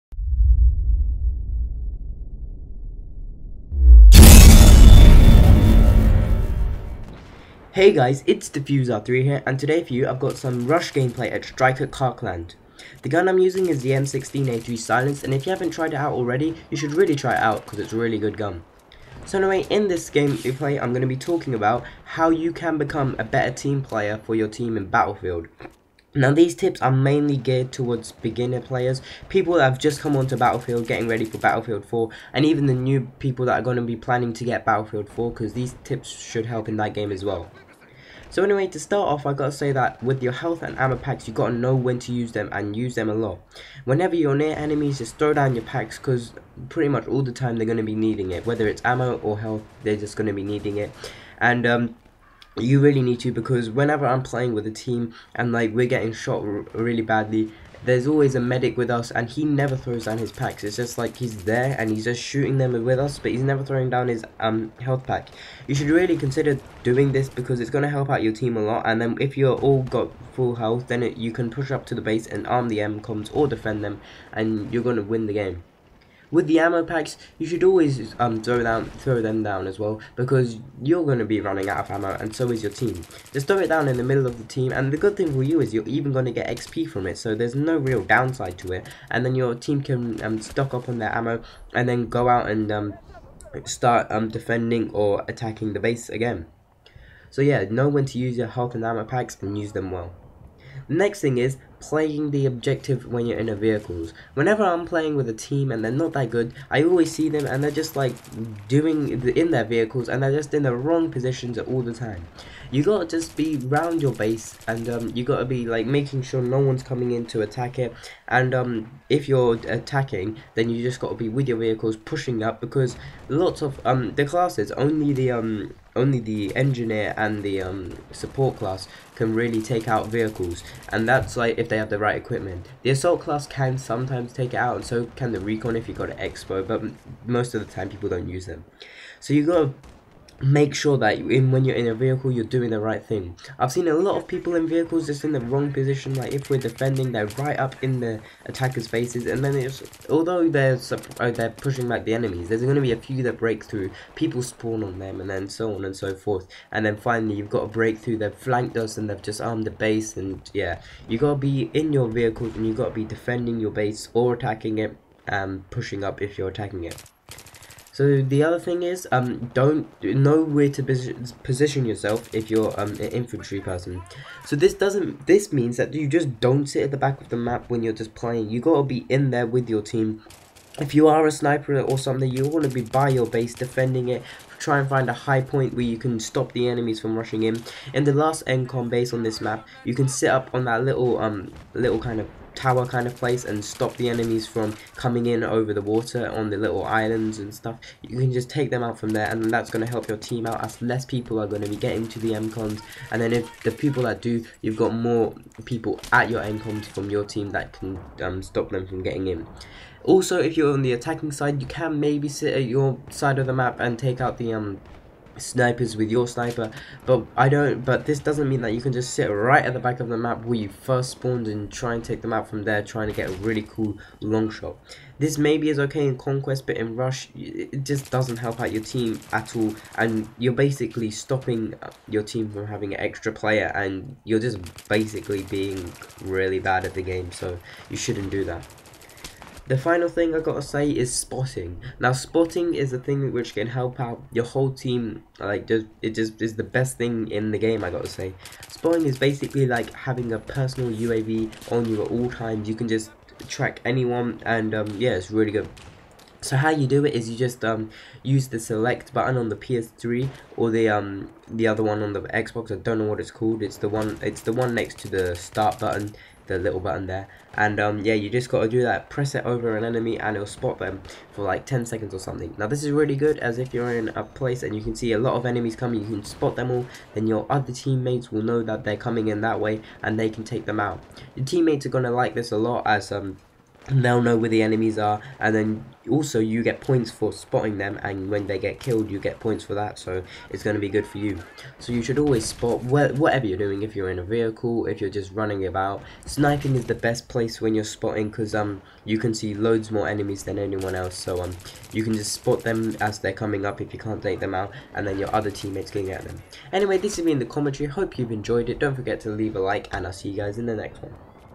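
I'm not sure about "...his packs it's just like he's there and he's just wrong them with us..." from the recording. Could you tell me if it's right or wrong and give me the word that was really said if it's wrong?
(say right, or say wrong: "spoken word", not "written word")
wrong: "shooting", not "wrong".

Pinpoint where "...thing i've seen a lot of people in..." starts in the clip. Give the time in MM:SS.
02:23.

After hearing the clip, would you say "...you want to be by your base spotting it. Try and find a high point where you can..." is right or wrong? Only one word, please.
wrong.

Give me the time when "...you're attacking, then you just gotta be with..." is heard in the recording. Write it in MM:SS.
01:59.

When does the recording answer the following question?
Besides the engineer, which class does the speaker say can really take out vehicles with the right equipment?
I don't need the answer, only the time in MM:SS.
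02:08.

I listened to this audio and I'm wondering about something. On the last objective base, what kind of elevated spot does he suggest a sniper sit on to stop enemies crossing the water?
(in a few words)
tower.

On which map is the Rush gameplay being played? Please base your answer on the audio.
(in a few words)
Strike at Karkand.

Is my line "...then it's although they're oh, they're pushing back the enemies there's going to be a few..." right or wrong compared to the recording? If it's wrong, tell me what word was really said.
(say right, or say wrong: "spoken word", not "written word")
right.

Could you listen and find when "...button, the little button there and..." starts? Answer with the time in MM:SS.
04:25.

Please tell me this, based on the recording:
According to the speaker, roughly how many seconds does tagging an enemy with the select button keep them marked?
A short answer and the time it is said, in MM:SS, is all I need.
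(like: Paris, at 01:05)
10, at 04:31.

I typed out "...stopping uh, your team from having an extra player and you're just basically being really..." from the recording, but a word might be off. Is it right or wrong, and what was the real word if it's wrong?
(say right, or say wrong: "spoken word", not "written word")
right.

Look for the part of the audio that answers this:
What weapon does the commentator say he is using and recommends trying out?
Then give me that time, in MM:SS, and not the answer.
00:13.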